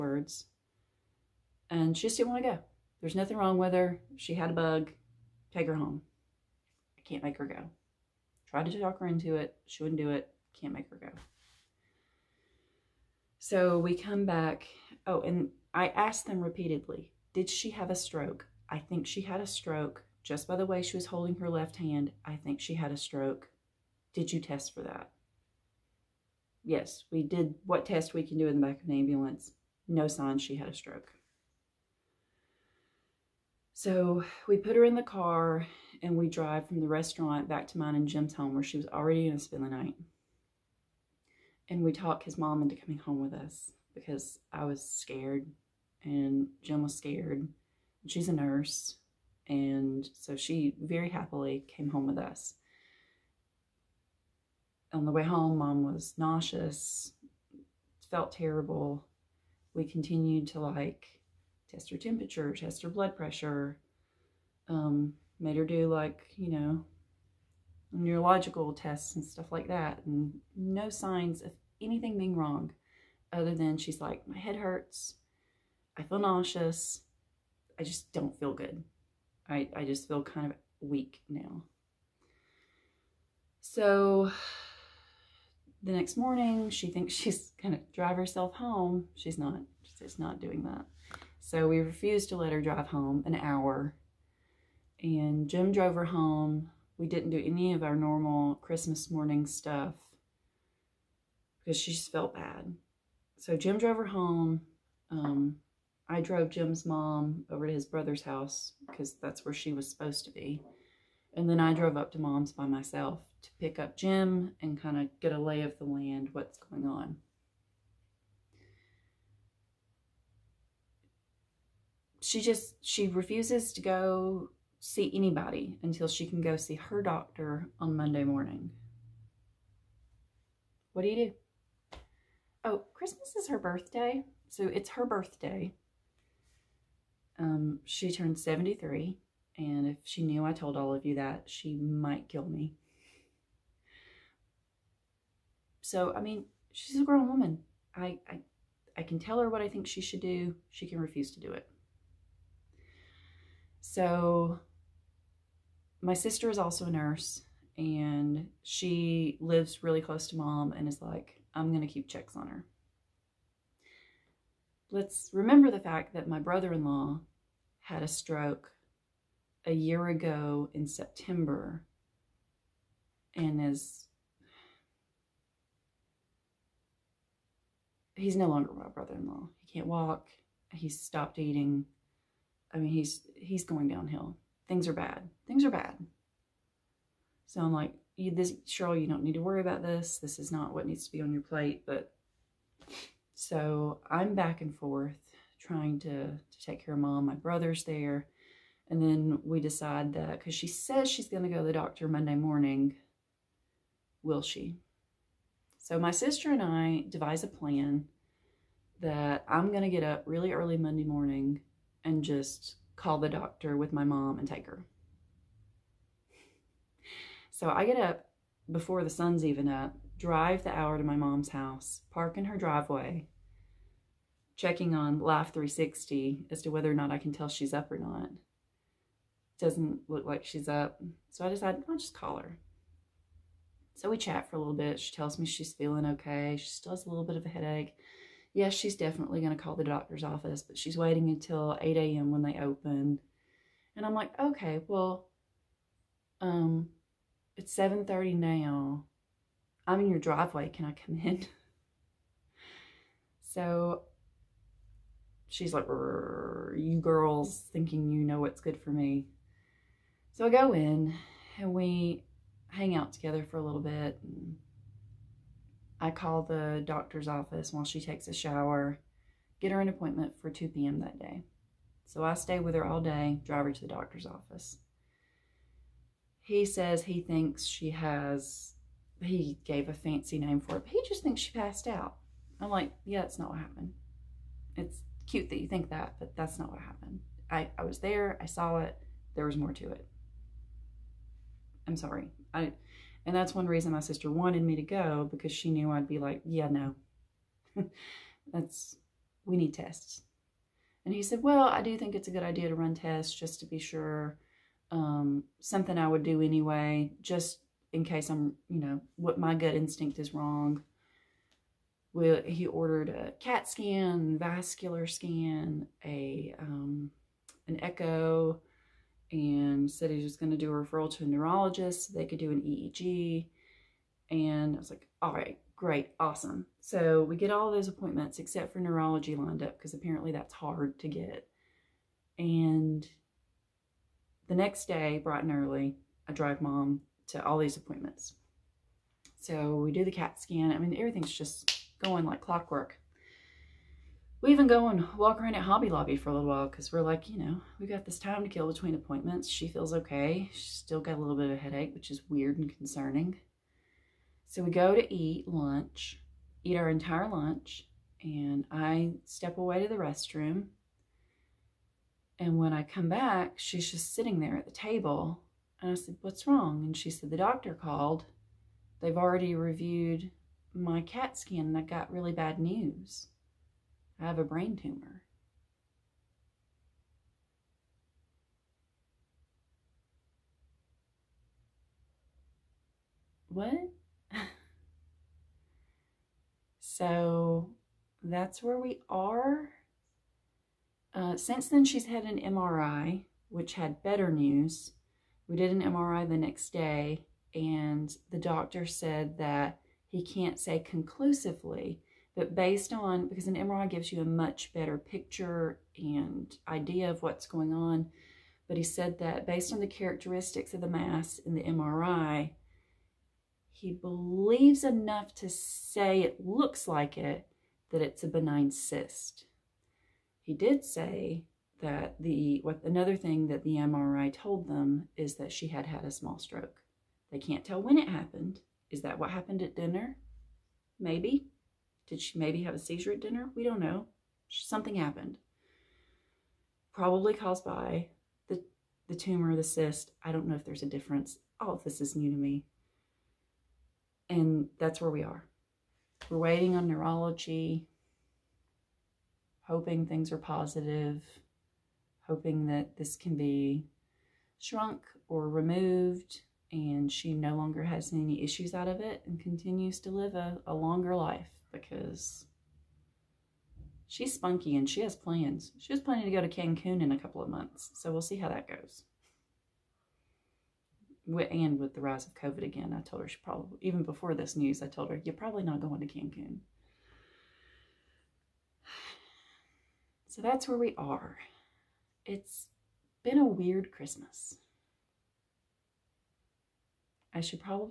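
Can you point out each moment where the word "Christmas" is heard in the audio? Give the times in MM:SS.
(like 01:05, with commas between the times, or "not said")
01:38, 02:12, 08:03.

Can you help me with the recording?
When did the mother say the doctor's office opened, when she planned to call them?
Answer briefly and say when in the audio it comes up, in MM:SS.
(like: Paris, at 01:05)
8 a.m., at 04:01.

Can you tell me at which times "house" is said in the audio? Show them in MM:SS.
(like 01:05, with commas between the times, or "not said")
01:48, 03:41.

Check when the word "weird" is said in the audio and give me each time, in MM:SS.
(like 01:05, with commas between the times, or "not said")
05:52, 08:03.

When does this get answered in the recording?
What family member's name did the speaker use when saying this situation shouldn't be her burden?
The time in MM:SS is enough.
03:08.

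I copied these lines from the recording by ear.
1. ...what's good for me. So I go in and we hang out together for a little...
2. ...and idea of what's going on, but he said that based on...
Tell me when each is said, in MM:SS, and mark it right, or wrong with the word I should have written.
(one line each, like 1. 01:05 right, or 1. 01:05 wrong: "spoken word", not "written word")
1. 04:18 right
2. 06:45 right.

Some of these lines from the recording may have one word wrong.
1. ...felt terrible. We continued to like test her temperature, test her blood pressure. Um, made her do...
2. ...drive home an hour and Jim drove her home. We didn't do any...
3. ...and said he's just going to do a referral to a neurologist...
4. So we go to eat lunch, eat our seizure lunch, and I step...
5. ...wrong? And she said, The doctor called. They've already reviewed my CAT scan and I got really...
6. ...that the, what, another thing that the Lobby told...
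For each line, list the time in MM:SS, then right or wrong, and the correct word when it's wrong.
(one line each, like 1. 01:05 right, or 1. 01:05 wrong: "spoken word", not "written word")
1. 00:58 right
2. 01:32 right
3. 05:19 right
4. 05:54 wrong: "entire", not "seizure"
5. 06:06 right
6. 07:01 wrong: "MRI", not "Lobby".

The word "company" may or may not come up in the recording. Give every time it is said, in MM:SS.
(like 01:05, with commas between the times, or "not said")
not said.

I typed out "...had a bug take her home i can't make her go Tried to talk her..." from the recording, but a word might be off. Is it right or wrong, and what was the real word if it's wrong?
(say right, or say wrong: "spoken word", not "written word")
right.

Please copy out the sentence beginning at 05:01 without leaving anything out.
And he said, well, I do think it's a good idea to run tests just to be sure.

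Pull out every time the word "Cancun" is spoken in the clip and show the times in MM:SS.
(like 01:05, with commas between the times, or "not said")
07:46, 07:56.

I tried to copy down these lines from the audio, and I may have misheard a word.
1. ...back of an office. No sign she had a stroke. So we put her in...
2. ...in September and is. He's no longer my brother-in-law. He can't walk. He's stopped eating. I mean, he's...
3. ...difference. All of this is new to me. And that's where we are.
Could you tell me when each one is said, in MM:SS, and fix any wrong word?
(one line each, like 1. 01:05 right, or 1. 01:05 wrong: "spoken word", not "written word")
1. 00:28 wrong: "ambulance", not "office"
2. 02:50 right
3. 07:20 right.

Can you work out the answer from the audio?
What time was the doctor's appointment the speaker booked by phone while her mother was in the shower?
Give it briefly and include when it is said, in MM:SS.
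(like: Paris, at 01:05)
2 p.m., at 04:30.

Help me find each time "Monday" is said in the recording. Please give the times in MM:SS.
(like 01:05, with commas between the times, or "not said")
02:07, 03:22, 03:30.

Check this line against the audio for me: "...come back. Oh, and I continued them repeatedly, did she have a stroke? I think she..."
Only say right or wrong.
wrong.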